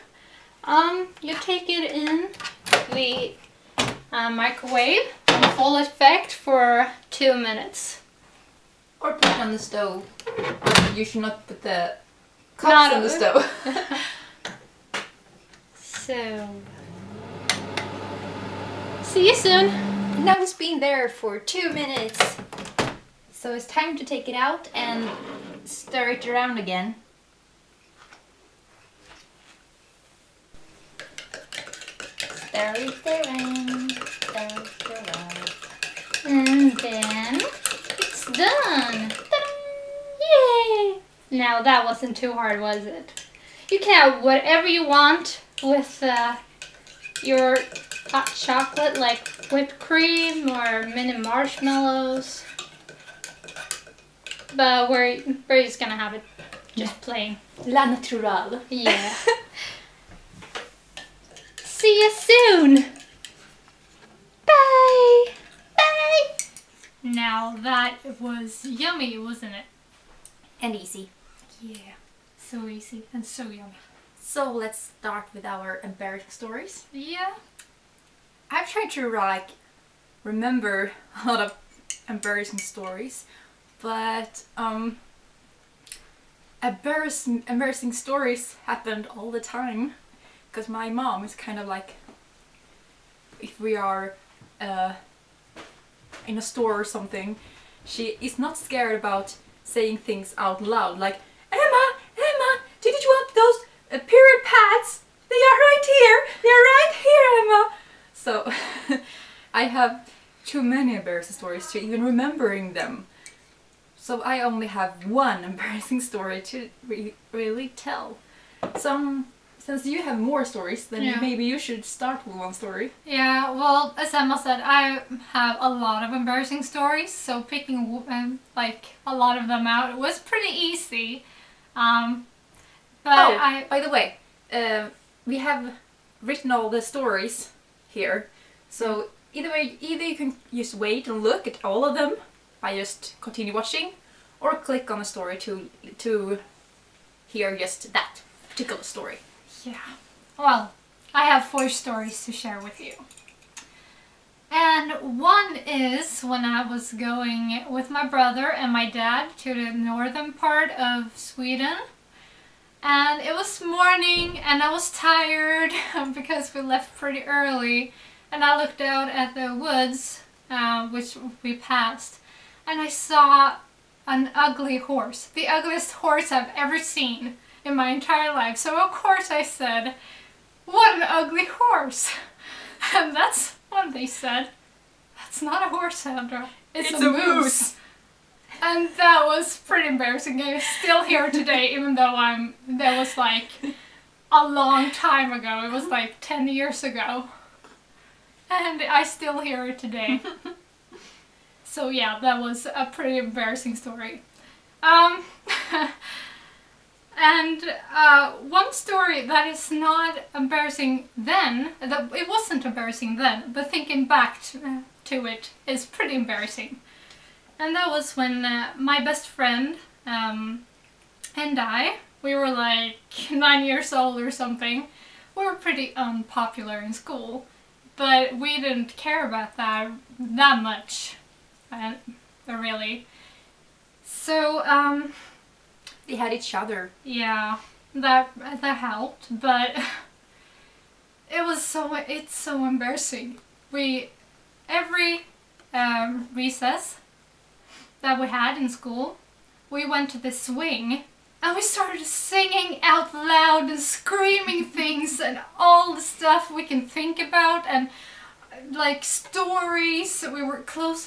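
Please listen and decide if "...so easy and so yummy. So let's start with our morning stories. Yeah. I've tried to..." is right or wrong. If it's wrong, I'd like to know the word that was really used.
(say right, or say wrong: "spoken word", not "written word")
wrong: "embarrassing", not "morning".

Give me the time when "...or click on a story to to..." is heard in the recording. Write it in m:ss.
2:24.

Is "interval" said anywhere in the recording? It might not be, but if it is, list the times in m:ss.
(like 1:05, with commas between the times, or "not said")
not said.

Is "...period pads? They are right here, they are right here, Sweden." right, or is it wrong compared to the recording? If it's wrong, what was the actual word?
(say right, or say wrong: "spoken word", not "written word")
wrong: "Emma", not "Sweden".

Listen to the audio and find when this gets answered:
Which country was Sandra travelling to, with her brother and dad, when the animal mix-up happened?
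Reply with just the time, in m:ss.
2:41.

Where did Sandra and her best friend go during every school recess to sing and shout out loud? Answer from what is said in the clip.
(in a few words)
The swing.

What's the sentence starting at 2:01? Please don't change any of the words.
maybe you should start with one story.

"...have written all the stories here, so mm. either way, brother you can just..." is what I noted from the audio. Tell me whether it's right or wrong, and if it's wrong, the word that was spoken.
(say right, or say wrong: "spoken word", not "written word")
wrong: "either", not "brother".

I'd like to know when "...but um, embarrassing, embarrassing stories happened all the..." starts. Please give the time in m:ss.
1:23.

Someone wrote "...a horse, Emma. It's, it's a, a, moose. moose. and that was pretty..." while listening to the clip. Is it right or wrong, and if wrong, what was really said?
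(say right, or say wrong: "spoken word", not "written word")
wrong: "Sandra", not "Emma".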